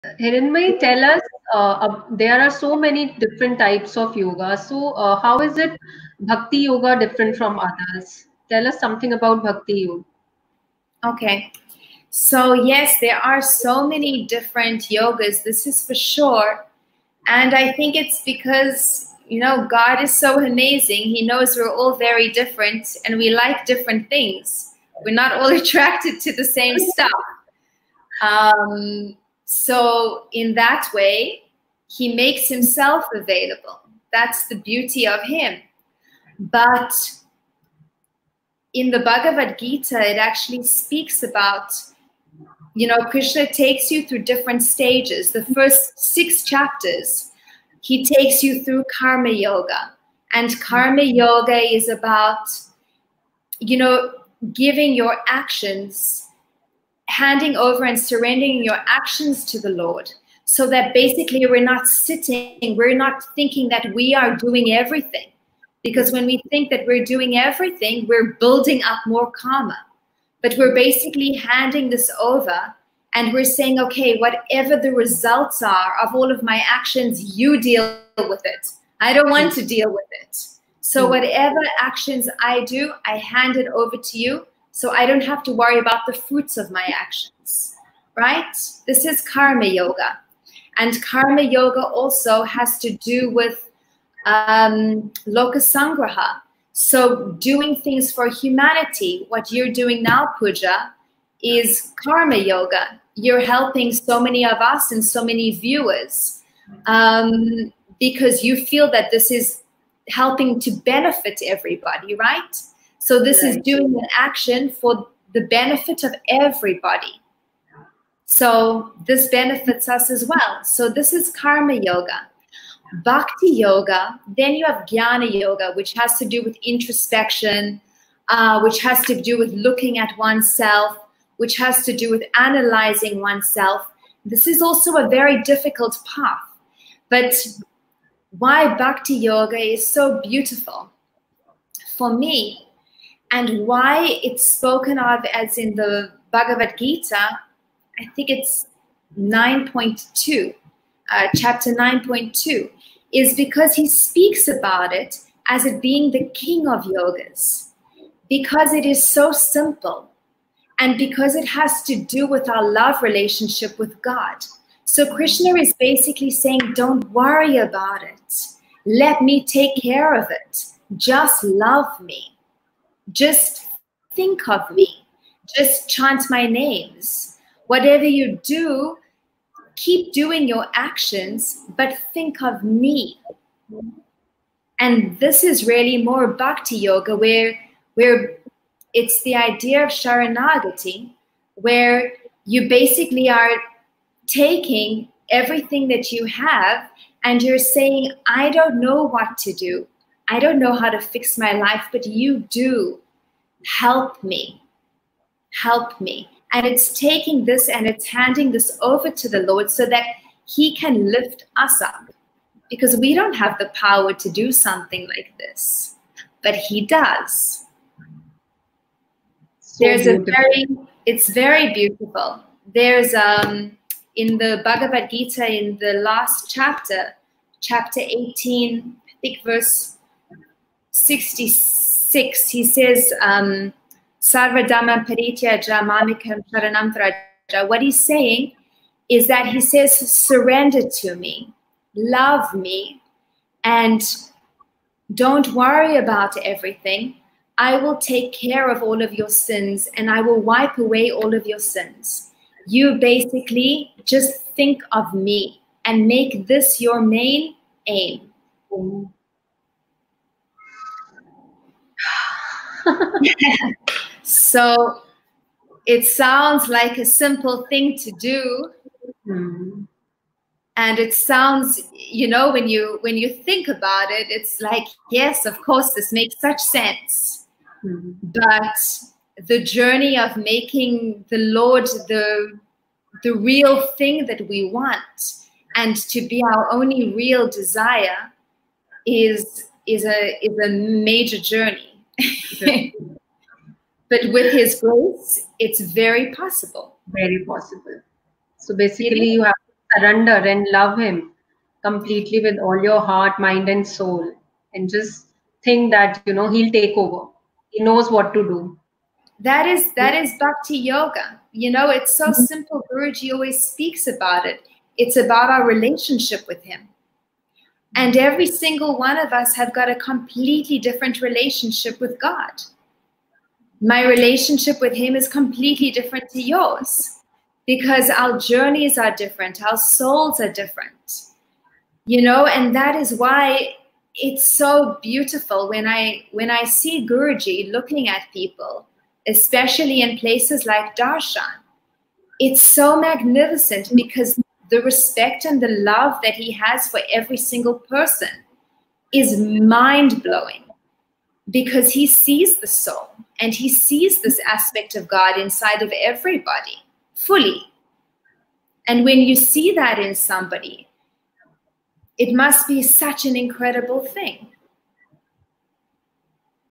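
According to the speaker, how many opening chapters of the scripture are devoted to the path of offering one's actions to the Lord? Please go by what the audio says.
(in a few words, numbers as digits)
6.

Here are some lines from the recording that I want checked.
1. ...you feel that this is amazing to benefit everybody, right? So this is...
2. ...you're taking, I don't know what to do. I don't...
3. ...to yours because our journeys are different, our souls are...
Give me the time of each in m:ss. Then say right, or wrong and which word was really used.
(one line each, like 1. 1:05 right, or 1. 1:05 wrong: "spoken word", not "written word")
1. 1:48 wrong: "helping", not "amazing"
2. 3:17 wrong: "saying", not "taking"
3. 5:26 right.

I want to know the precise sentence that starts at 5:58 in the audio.
And when you see that in somebody, it must be such an incredible thing.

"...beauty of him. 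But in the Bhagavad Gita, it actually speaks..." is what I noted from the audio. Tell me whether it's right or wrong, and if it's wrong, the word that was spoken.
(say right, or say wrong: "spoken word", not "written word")
right.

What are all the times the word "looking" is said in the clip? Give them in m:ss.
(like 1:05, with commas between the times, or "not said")
2:09, 5:37.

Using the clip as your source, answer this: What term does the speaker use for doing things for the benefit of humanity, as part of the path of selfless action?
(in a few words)
lokasangraha.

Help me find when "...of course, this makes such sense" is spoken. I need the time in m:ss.
4:35.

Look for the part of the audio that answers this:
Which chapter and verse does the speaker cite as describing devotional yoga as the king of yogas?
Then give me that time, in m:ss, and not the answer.
2:31.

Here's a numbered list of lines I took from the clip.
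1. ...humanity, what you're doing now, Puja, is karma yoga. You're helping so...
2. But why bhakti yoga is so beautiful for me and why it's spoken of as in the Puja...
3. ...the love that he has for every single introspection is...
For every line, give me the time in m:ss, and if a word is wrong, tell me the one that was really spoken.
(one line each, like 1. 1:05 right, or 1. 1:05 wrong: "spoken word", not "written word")
1. 1:38 right
2. 2:17 wrong: "Bhagavad", not "Puja"
3. 5:45 wrong: "person", not "introspection".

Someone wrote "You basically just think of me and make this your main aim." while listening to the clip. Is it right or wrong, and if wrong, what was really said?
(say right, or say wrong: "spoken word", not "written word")
right.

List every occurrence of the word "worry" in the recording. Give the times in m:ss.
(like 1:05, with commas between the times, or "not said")
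1:25, 2:47, 4:05.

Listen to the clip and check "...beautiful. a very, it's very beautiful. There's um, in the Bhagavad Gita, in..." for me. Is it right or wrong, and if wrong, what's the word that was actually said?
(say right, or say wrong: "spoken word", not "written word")
right.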